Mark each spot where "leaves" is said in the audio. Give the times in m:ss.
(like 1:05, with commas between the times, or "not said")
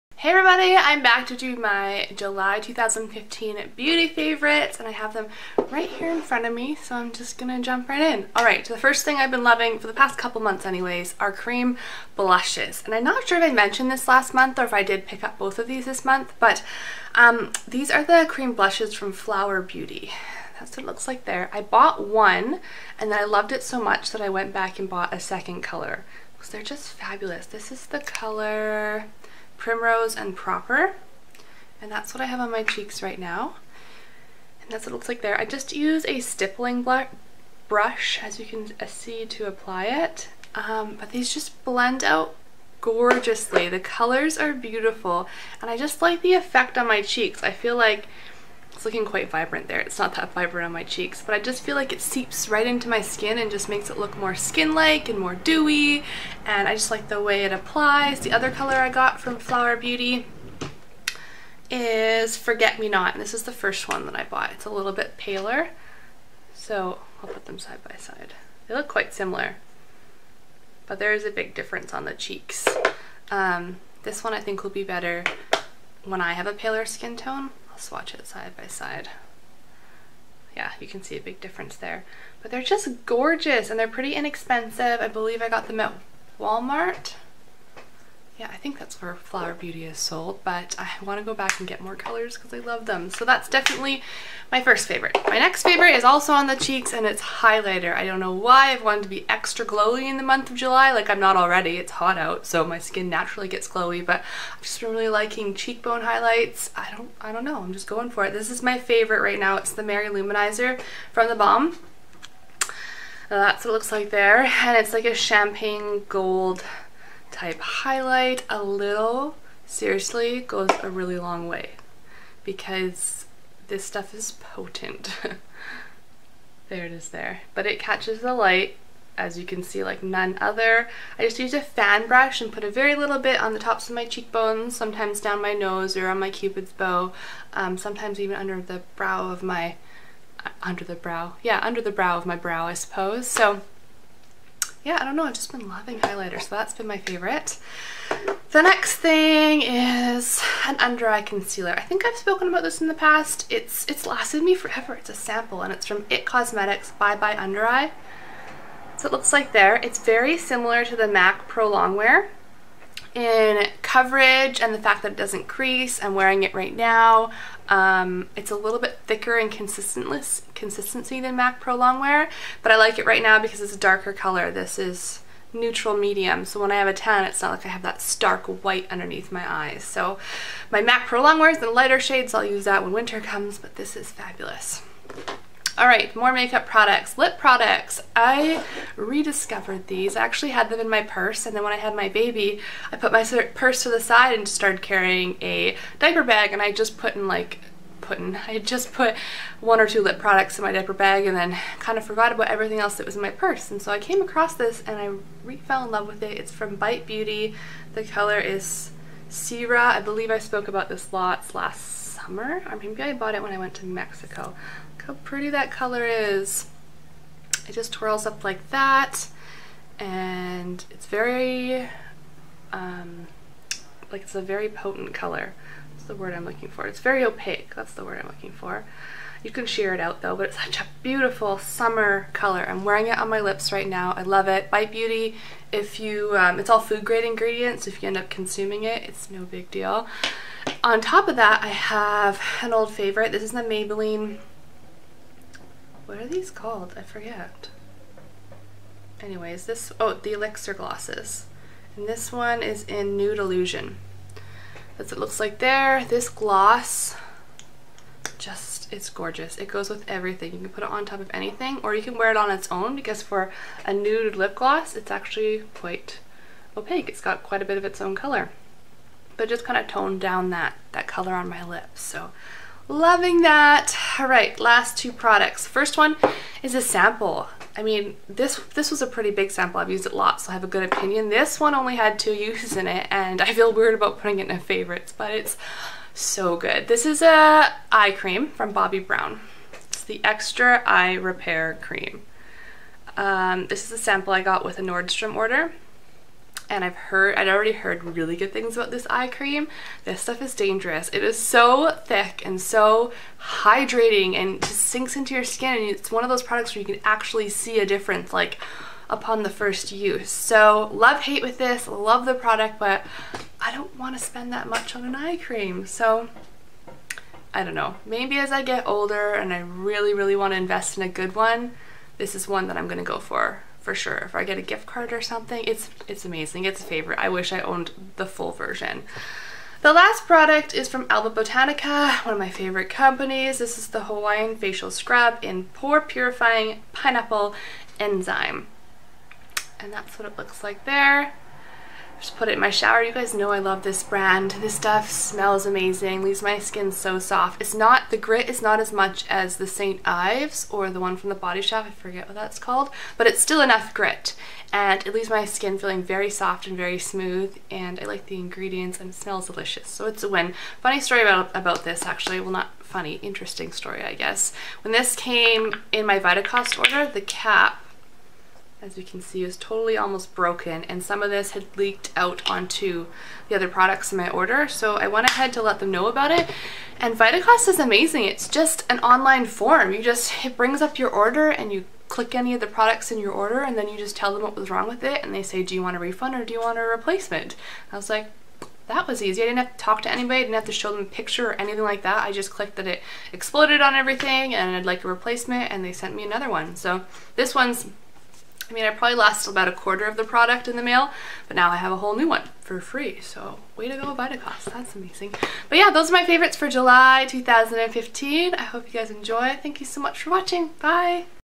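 5:46, 5:55.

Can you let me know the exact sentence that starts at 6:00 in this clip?
Funny story about, about this actually, well not funny, interesting story I guess.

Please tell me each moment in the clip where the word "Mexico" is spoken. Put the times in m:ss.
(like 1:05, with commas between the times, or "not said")
3:33.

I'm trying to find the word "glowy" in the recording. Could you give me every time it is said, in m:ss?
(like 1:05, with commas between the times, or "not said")
1:39, 1:43.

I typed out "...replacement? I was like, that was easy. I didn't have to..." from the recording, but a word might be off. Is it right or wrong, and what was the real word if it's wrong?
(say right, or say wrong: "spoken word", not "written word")
right.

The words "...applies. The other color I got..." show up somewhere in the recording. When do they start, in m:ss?
0:57.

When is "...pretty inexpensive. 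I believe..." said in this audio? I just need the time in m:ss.
1:23.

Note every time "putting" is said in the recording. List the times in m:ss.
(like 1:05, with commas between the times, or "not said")
3:17, 4:44.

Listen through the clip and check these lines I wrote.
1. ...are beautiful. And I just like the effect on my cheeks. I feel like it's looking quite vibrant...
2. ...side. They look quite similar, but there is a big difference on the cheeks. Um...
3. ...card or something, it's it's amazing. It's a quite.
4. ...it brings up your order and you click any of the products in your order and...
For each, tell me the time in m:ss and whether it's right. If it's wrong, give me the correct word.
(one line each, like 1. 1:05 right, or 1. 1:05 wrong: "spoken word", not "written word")
1. 0:44 right
2. 1:07 right
3. 5:24 wrong: "favorite", not "quite"
4. 6:20 right.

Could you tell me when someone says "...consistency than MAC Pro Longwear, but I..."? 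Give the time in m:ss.
2:49.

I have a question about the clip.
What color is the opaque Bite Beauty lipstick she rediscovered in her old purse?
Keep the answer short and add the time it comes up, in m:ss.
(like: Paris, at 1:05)
Sierra, at 3:29.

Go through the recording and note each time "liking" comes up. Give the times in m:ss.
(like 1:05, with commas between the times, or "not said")
1:45.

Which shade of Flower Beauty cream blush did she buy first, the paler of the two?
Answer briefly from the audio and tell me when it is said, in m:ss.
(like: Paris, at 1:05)
Forget Me Not, at 1:02.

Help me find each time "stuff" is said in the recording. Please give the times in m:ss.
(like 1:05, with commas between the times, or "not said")
2:03, 5:00, 5:44.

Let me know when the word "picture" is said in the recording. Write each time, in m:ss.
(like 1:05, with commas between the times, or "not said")
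6:31.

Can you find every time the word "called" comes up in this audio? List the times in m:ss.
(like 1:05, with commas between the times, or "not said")
4:06, 5:52.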